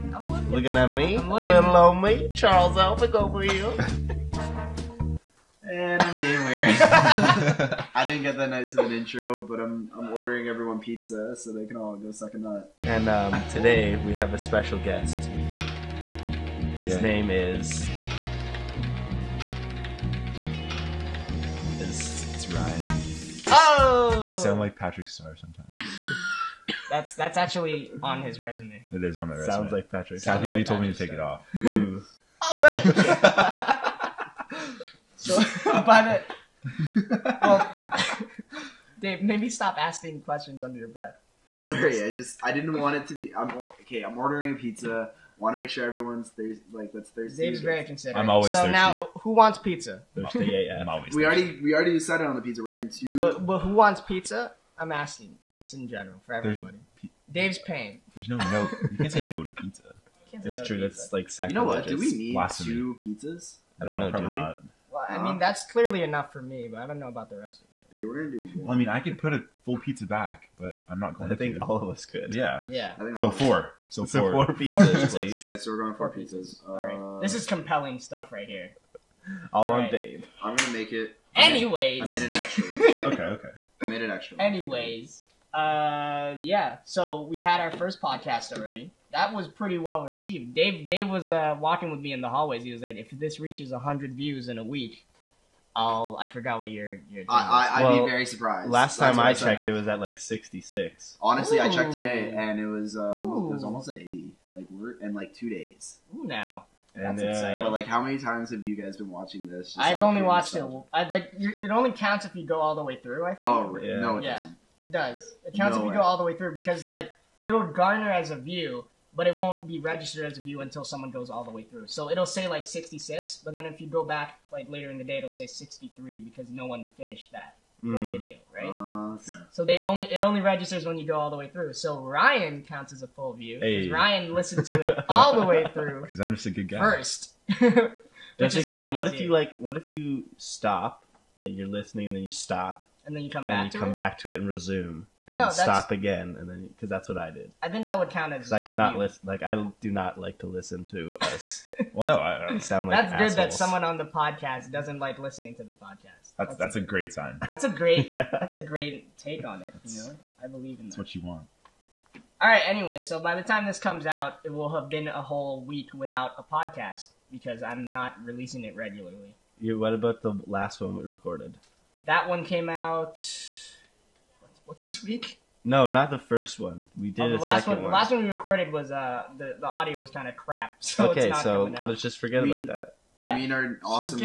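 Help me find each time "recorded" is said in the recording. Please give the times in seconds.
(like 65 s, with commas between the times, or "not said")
171 s, 178 s.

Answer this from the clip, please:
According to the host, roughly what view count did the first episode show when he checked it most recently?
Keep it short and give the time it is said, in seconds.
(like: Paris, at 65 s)
almost 80, at 103 s.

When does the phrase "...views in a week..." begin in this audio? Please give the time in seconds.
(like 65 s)
94 s.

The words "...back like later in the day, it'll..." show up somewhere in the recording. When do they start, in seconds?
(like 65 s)
124 s.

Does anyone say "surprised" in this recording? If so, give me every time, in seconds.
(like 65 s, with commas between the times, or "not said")
98 s.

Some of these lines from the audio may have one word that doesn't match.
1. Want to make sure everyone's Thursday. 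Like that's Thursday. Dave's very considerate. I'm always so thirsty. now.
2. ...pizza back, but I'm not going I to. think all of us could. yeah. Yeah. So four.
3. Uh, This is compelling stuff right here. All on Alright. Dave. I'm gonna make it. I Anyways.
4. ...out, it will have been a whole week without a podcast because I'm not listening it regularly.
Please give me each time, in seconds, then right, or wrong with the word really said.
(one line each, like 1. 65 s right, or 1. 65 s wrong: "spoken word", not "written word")
1. 45 s right
2. 69 s right
3. 76 s right
4. 164 s wrong: "releasing", not "listening".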